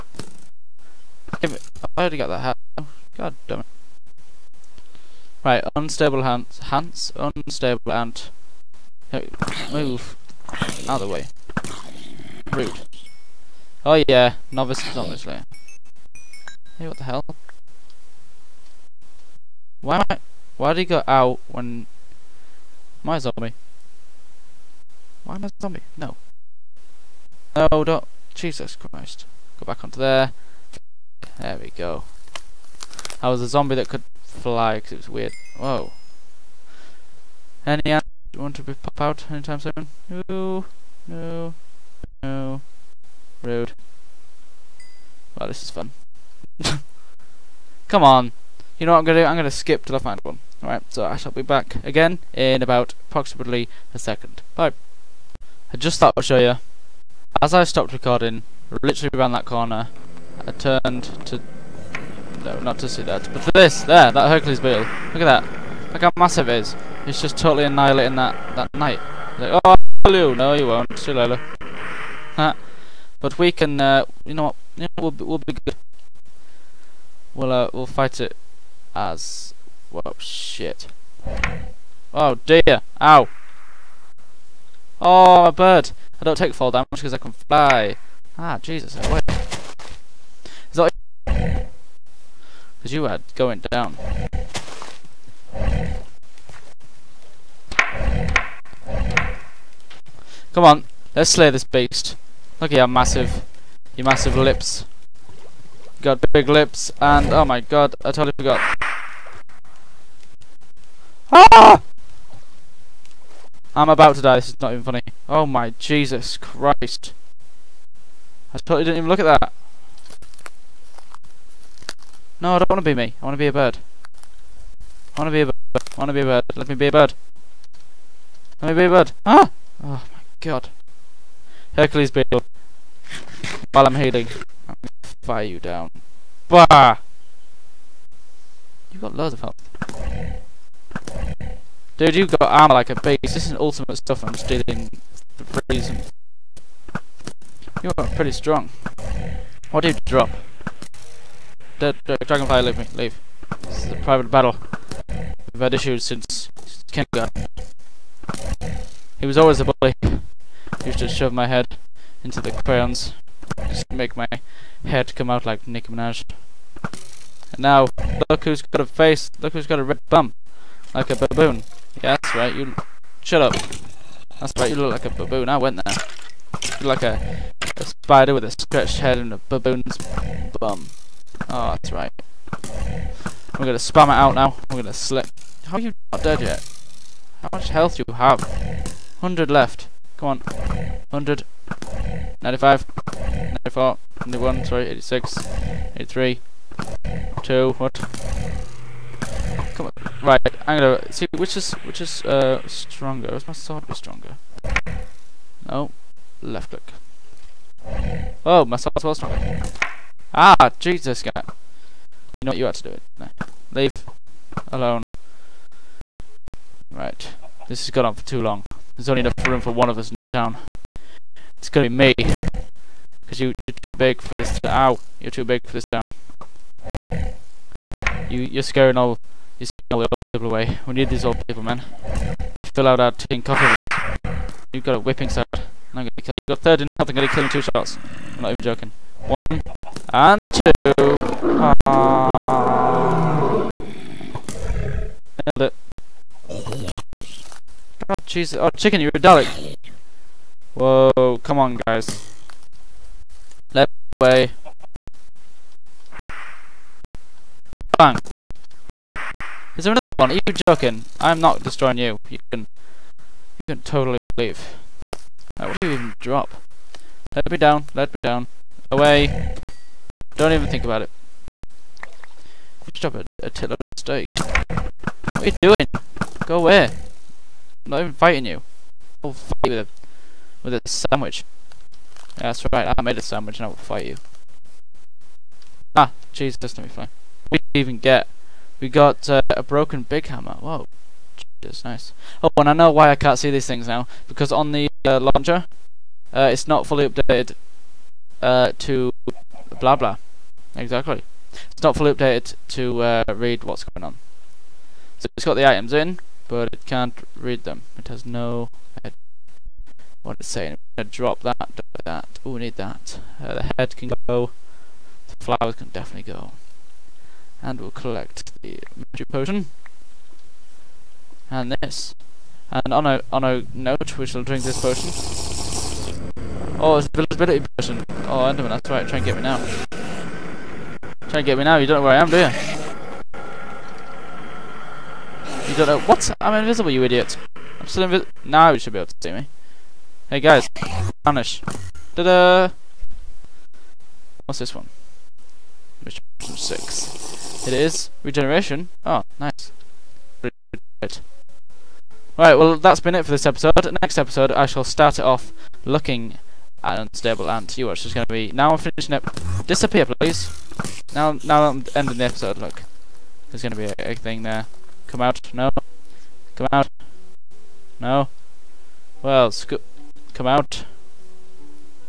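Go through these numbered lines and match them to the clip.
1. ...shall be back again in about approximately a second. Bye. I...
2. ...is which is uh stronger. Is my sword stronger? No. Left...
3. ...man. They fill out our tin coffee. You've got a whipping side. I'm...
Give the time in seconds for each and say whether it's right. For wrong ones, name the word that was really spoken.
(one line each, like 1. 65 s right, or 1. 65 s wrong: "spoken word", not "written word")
1. 51 s right
2. 201 s right
3. 231 s right.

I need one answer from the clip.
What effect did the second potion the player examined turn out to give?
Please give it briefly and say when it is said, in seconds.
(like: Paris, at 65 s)
regeneration, at 348 s.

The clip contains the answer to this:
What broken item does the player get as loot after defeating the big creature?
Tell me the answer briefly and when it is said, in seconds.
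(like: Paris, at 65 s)
broken big hammer, at 289 s.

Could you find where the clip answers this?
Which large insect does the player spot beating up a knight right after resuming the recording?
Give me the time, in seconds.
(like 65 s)
64 s.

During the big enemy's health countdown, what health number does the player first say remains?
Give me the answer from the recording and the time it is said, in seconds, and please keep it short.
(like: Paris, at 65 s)
100, at 189 s.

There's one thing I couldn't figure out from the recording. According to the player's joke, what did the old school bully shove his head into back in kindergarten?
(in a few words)
crayons.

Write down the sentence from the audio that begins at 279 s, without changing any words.
I'll fight you with a, with a sandwich.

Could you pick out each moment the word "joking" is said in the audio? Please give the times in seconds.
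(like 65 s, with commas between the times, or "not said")
238 s, 260 s.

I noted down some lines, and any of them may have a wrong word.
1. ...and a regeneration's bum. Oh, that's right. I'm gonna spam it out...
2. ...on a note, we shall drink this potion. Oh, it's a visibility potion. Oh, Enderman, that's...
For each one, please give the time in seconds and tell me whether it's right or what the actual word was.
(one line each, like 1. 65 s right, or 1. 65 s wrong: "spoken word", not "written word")
1. 179 s wrong: "baboon", not "regeneration"
2. 323 s right.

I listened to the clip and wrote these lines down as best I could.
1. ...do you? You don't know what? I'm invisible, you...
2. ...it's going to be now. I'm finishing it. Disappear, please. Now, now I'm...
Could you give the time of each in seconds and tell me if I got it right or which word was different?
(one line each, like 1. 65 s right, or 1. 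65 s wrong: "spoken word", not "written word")
1. 332 s right
2. 358 s right.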